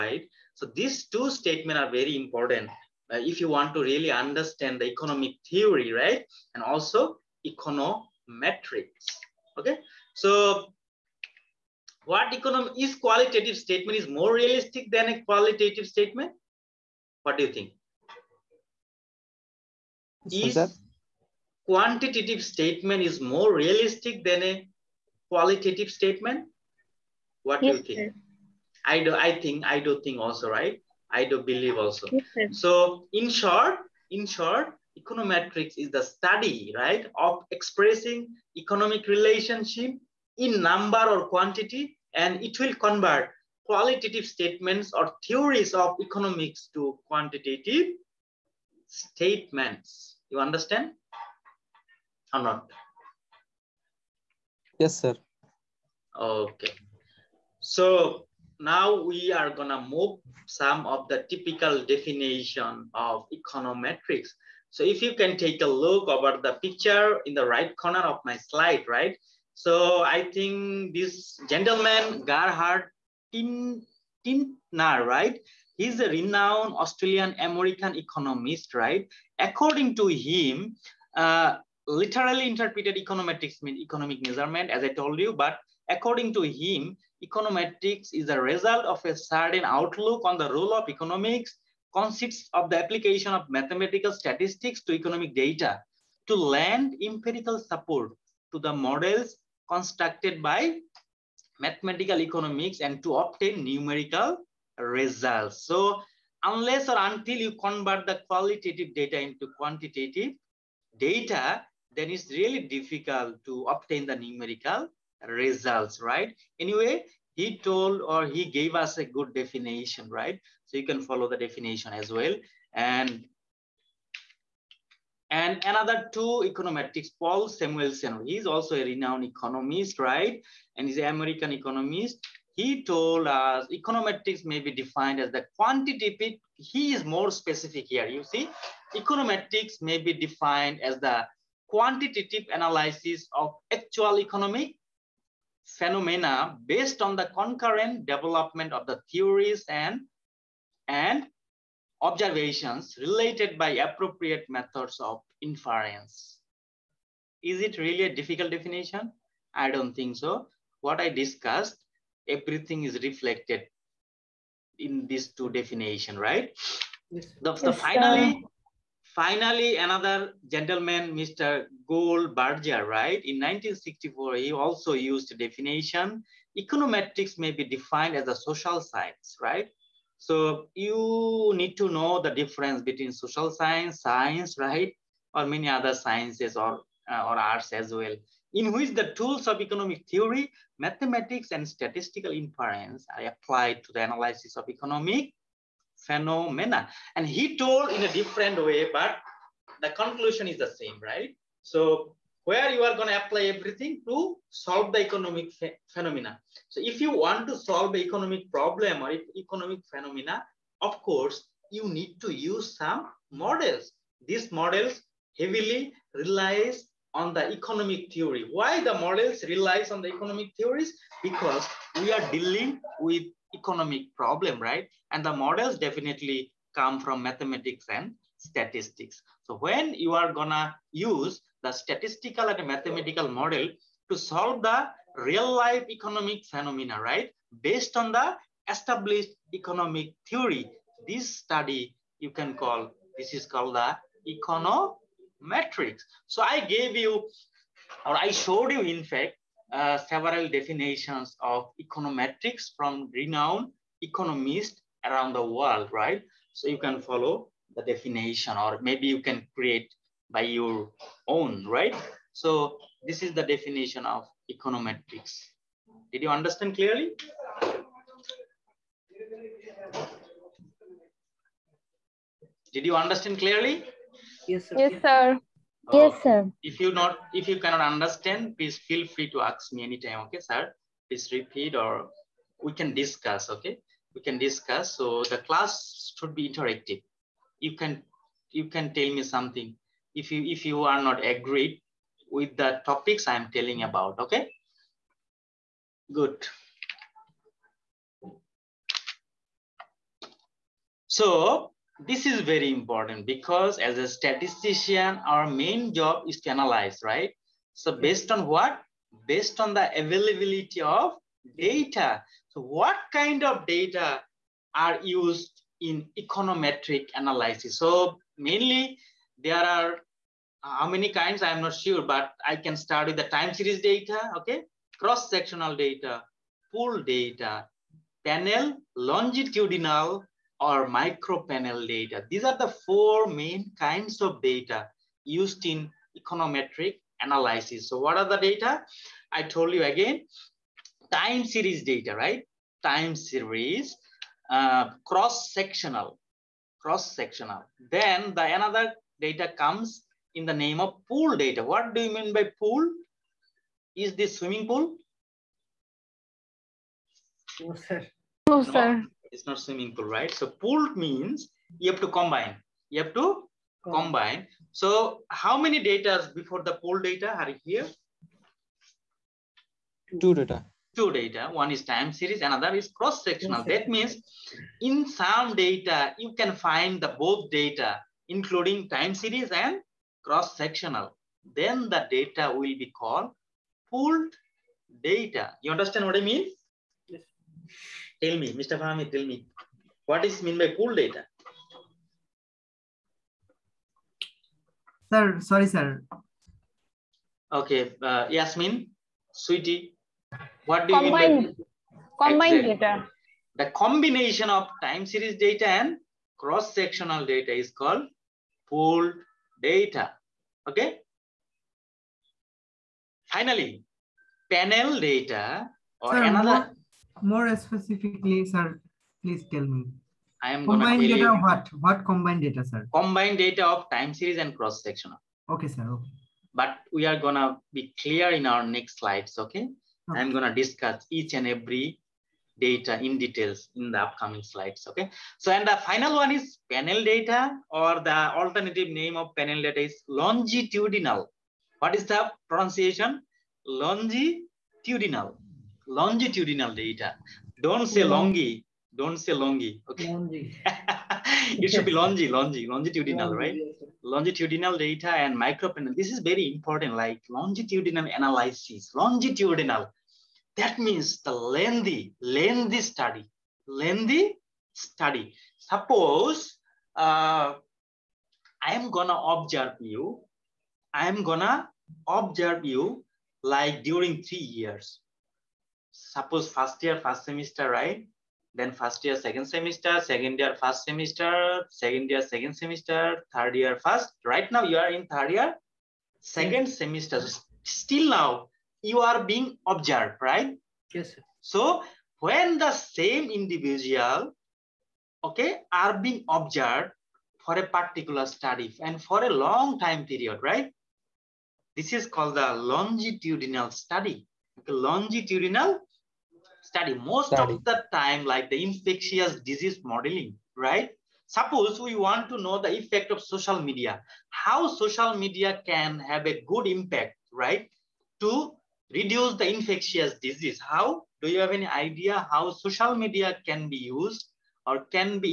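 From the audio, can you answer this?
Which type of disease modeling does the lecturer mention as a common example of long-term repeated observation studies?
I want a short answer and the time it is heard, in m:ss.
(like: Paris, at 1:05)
Infectious disease modeling, at 8:28.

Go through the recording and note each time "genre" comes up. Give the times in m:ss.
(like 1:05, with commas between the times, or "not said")
not said.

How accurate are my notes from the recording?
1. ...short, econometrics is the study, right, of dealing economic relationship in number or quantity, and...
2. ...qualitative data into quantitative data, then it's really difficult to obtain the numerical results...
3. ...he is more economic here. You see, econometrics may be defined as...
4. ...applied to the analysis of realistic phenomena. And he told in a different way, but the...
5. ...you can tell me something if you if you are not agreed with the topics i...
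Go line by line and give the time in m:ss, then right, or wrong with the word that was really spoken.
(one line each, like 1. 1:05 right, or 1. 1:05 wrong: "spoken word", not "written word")
1. 0:34 wrong: "expressing", not "dealing"
2. 1:48 right
3. 2:16 wrong: "specific", not "economic"
4. 3:13 wrong: "economic", not "realistic"
5. 4:48 right.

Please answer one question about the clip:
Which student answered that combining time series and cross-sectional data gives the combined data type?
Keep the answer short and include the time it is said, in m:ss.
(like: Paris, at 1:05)
Yasmin, at 6:38.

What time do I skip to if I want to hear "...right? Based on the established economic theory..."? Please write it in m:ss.
3:57.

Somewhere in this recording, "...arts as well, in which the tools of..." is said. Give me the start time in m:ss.
3:07.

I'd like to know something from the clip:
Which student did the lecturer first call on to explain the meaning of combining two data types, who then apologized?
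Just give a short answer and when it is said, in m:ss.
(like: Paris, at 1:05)
Fahmi, at 6:28.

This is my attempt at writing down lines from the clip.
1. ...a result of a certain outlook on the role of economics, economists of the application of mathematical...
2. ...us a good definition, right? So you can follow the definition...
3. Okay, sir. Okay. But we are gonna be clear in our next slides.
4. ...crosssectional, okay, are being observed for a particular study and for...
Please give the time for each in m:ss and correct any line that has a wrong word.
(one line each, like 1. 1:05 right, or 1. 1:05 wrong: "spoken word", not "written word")
1. 1:28 wrong: "consists", not "economists"
2. 1:58 right
3. 7:05 right
4. 8:13 wrong: "individual", not "crosssectional".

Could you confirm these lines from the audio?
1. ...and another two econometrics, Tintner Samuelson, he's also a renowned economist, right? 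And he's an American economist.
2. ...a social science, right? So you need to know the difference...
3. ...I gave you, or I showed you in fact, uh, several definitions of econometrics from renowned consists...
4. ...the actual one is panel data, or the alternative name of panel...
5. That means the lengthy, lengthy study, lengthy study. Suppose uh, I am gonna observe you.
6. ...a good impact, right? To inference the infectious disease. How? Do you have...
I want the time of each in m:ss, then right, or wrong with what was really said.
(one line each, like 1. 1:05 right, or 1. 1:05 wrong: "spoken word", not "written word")
1. 2:05 wrong: "Paul", not "Tintner"
2. 2:58 right
3. 4:06 wrong: "economists", not "consists"
4. 7:15 wrong: "final", not "actual"
5. 7:40 right
6. 8:36 wrong: "reduce", not "inference".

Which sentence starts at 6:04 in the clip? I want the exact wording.
So how many data before the pool data are here?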